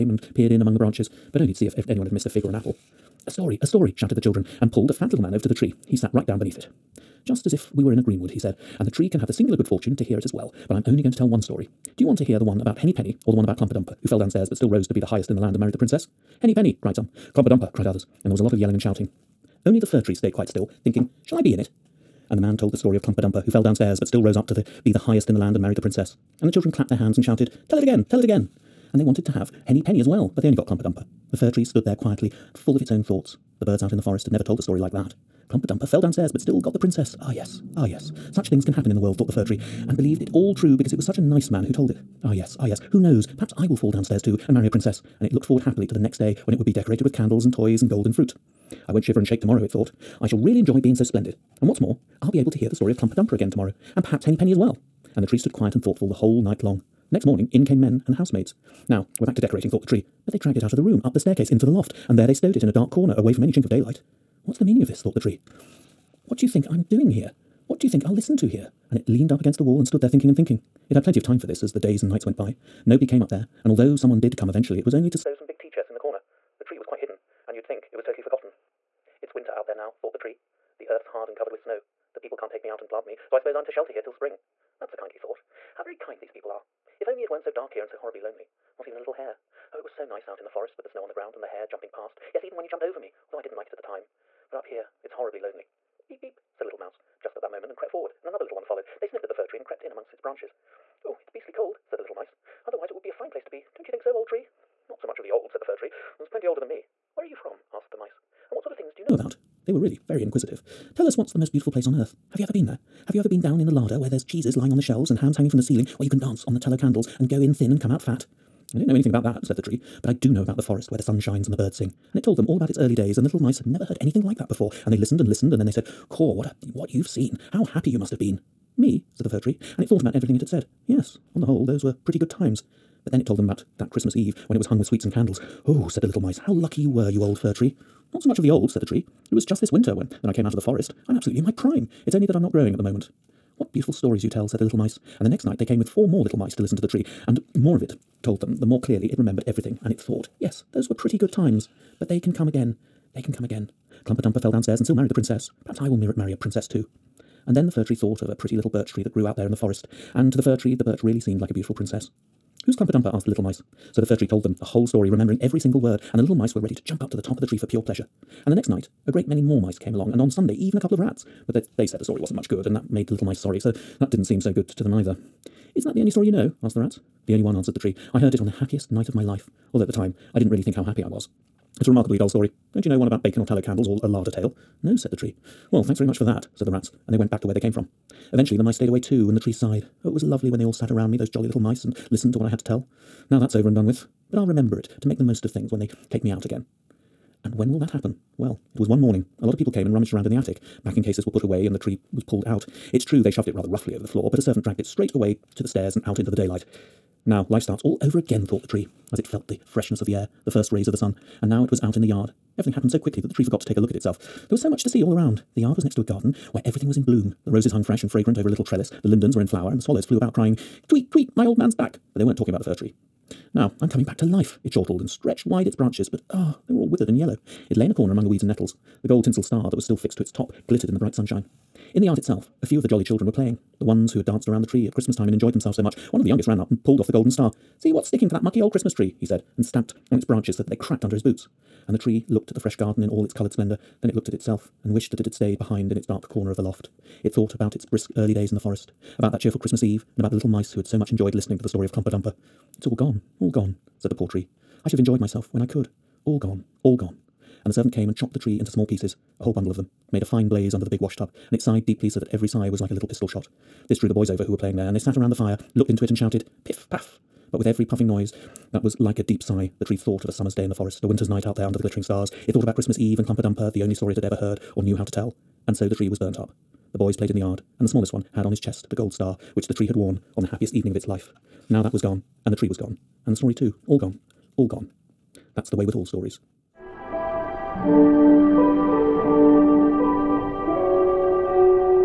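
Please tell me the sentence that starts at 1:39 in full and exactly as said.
They sniffed at the fir tree and crept in amongst its branches.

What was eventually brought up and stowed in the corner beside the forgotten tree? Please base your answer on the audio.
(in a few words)
tea chests.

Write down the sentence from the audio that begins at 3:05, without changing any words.
Well, thanks very much for that, said the rats, and they went back to where they came from.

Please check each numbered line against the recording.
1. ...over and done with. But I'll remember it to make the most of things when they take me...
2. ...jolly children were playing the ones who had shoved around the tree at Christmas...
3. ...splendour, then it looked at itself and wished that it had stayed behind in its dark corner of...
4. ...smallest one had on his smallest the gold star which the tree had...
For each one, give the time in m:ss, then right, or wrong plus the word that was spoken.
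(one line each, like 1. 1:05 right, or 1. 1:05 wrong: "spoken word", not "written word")
1. 3:13 right
2. 3:52 wrong: "danced", not "shoved"
3. 4:03 right
4. 4:37 wrong: "chest", not "smallest".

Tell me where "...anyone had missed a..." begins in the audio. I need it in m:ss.
0:01.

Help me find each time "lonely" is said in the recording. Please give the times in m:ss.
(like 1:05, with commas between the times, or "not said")
1:28, 1:35.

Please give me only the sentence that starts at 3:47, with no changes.
It lay in a corner among the weeds and nettles.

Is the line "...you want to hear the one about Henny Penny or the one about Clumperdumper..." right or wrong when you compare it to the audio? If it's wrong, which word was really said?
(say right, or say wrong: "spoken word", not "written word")
right.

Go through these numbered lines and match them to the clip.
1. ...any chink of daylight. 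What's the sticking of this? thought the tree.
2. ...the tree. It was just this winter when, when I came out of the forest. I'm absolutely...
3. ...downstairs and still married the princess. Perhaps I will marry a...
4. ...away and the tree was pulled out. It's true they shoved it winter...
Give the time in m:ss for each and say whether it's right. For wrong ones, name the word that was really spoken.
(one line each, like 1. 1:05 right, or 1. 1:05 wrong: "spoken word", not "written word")
1. 1:03 wrong: "meaning", not "sticking"
2. 2:18 right
3. 2:34 right
4. 3:21 wrong: "rather", not "winter".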